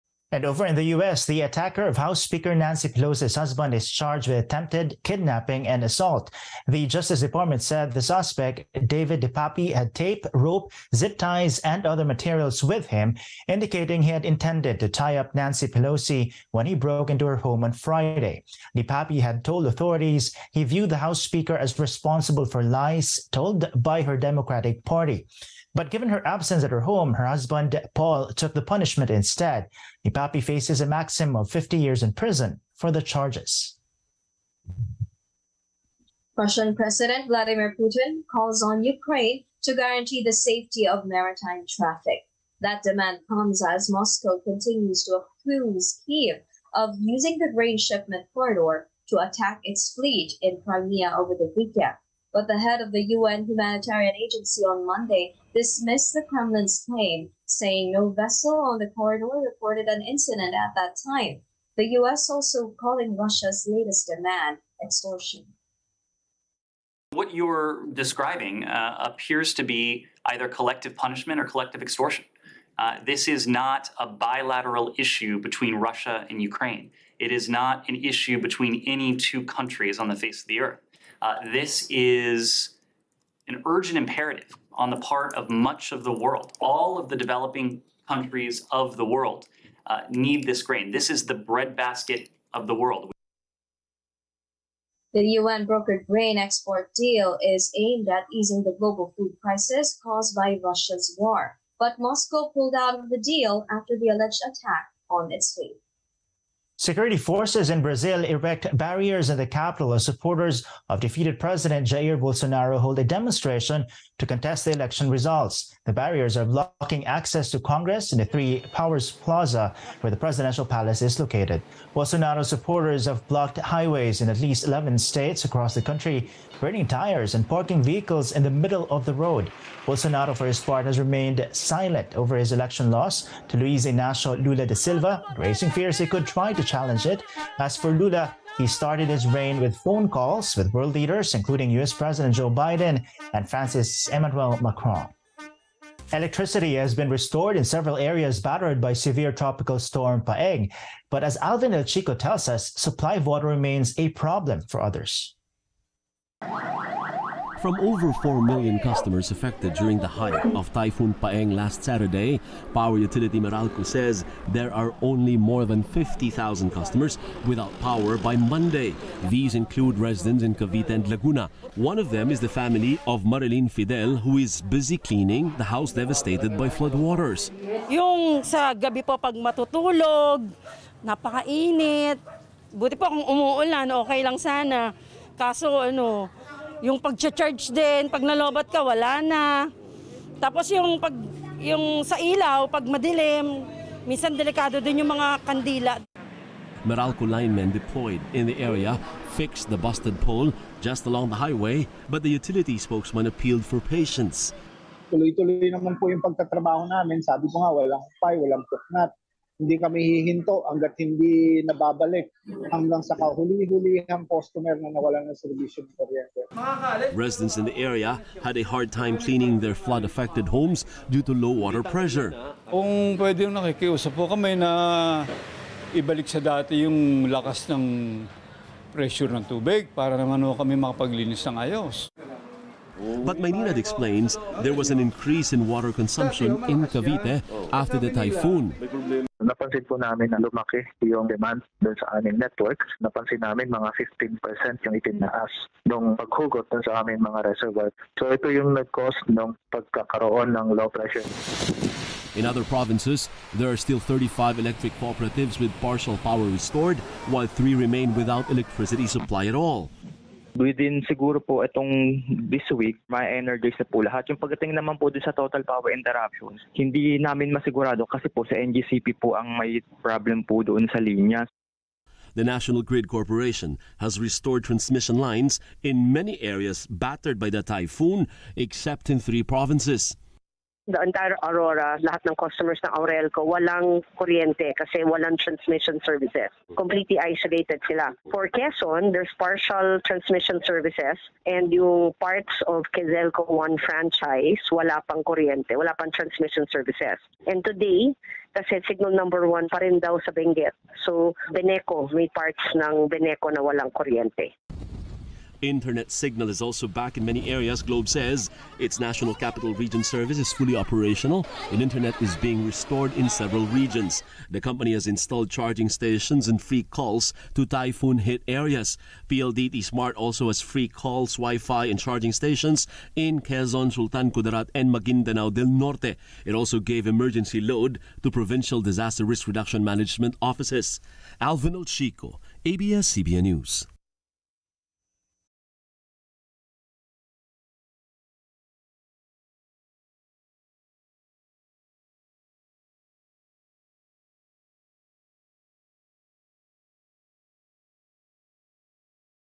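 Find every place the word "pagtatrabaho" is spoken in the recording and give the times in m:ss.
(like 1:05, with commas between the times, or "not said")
3:26.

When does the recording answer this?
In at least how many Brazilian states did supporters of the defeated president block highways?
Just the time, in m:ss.
2:04.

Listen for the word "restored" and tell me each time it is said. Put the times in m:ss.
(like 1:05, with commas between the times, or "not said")
2:27, 4:16, 4:34, 5:12.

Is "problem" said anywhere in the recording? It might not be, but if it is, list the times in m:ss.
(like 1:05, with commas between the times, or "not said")
2:34, 4:30.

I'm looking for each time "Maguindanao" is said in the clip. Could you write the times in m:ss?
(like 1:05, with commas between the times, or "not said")
5:24.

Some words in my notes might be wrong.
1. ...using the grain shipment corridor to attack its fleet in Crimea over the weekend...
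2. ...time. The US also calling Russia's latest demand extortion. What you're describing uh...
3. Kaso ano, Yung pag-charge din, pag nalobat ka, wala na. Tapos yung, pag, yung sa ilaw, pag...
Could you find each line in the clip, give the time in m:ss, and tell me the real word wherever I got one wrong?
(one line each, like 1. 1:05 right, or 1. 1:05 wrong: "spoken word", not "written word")
1. 0:46 right
2. 1:01 right
3. 3:05 right.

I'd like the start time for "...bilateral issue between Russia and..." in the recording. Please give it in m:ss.
1:14.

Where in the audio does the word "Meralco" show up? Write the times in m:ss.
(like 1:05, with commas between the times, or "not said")
2:43, 3:16.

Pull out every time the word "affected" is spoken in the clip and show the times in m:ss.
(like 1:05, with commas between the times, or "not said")
2:39, 3:39.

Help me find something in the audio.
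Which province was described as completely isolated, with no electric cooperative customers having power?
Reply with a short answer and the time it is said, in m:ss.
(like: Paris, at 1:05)
Aurora, at 4:41.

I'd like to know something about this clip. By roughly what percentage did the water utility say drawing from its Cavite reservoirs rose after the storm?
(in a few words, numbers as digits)
15%.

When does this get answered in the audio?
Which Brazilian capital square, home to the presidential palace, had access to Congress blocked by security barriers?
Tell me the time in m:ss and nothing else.
1:58.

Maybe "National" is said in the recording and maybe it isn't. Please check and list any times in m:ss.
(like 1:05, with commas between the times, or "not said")
4:32, 5:08.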